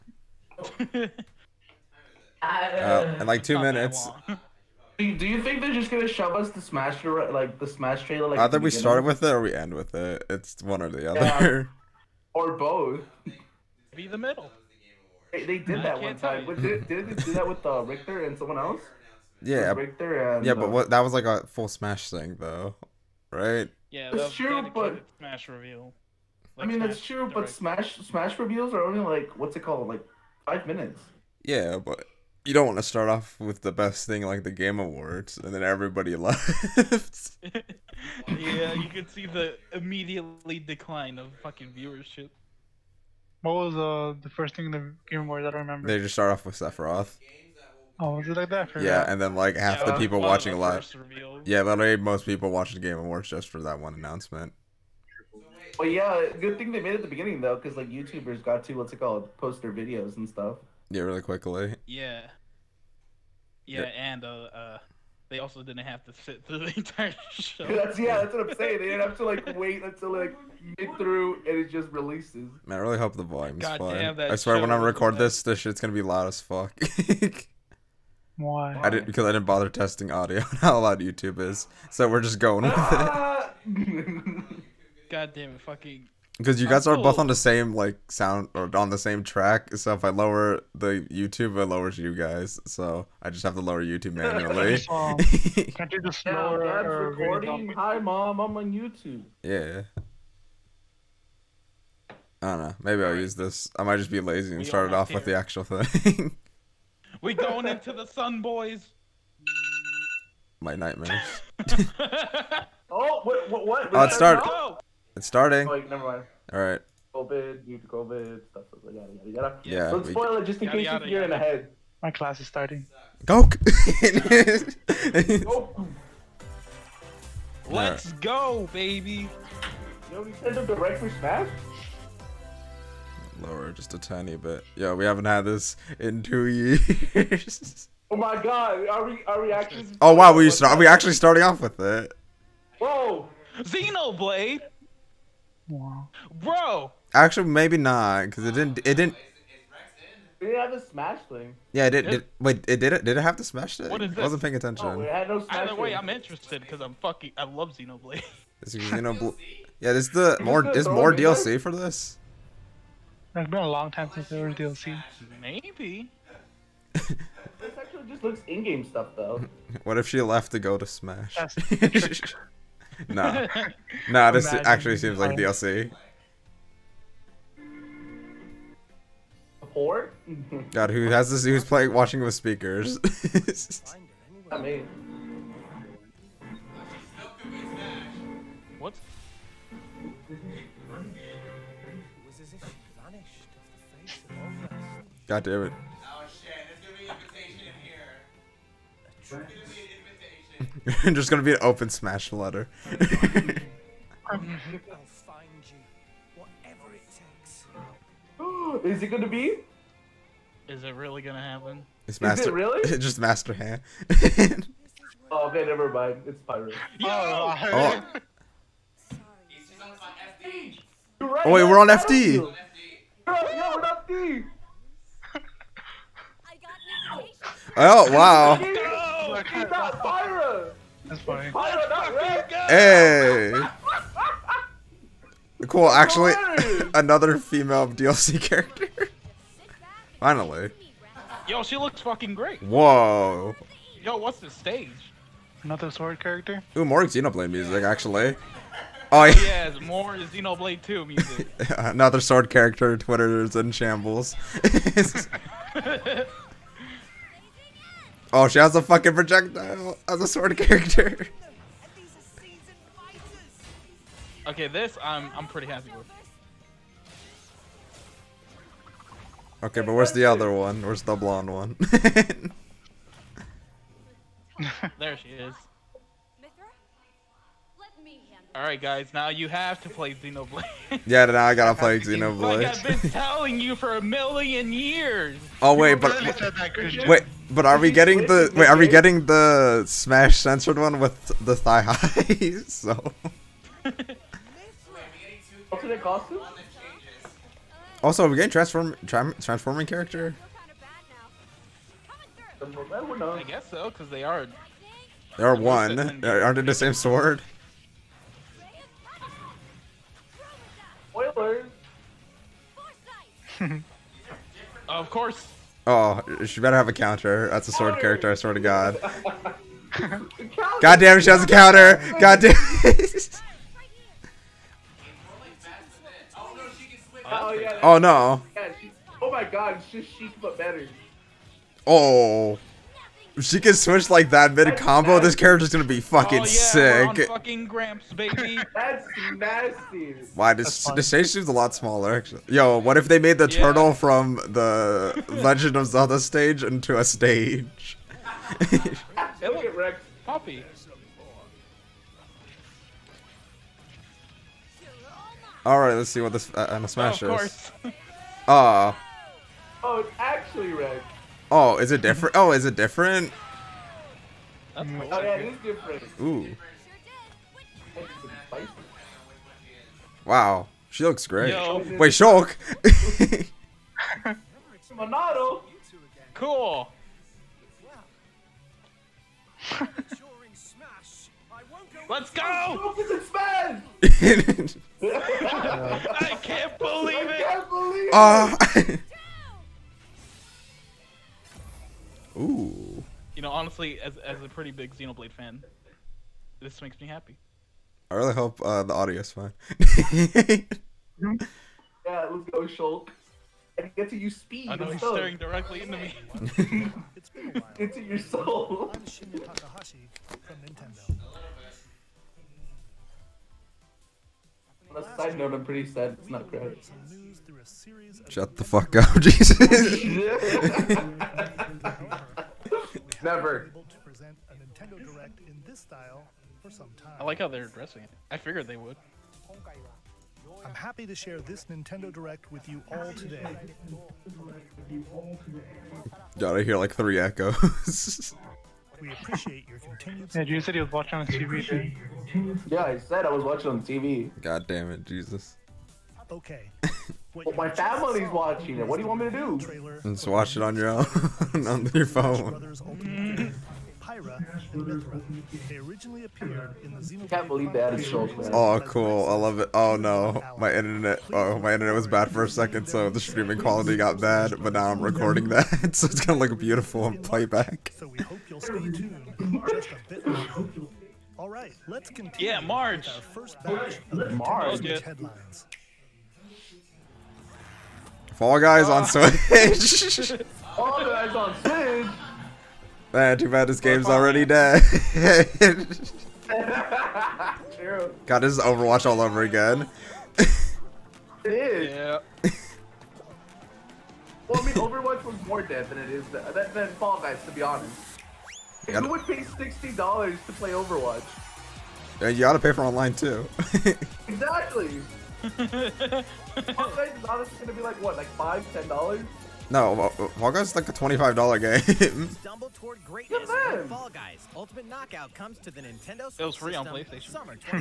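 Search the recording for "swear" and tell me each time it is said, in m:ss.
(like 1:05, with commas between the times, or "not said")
1:14, 5:18.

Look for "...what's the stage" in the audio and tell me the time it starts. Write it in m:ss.
4:04.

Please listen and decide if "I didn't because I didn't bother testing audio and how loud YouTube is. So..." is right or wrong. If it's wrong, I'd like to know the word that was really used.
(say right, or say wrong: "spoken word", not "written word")
right.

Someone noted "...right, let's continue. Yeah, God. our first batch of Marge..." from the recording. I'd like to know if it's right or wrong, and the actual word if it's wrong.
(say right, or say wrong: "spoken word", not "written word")
wrong: "Marge", not "God".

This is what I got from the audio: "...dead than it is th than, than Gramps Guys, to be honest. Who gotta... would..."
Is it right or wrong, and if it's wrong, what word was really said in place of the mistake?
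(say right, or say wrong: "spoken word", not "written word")
wrong: "Fall", not "Gramps".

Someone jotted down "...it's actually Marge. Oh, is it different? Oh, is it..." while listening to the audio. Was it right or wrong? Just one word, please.
wrong.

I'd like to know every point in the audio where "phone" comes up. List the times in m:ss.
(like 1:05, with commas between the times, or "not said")
7:32.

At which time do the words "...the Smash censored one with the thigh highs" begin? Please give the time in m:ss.
4:49.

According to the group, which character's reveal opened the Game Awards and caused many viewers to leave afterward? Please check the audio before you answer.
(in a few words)
Sephiroth.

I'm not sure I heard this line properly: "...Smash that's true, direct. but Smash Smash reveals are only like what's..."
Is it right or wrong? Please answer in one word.
right.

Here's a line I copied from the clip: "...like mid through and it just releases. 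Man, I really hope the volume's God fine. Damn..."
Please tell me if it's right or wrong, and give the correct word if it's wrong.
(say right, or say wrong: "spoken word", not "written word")
right.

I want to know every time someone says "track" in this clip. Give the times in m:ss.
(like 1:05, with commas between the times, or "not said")
1:29.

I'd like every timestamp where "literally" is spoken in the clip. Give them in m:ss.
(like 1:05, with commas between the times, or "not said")
0:51.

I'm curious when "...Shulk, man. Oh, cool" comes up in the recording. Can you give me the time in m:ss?
7:37.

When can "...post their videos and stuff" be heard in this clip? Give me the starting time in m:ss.
0:59.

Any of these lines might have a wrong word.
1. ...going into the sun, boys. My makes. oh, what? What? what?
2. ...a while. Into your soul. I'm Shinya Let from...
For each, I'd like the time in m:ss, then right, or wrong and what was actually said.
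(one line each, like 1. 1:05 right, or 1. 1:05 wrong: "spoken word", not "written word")
1. 1:47 wrong: "nightmares", not "makes"
2. 6:47 wrong: "Takahashi", not "Let".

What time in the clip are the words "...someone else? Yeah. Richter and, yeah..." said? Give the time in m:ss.
0:18.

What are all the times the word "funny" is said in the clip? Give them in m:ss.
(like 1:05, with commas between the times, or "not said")
3:51.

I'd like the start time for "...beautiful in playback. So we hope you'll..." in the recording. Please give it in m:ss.
7:46.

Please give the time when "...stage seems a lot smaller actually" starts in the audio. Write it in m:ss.
5:41.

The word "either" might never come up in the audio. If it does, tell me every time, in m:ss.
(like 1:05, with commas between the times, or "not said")
0:08, 2:35.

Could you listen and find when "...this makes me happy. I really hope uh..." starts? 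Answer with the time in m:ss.
6:36.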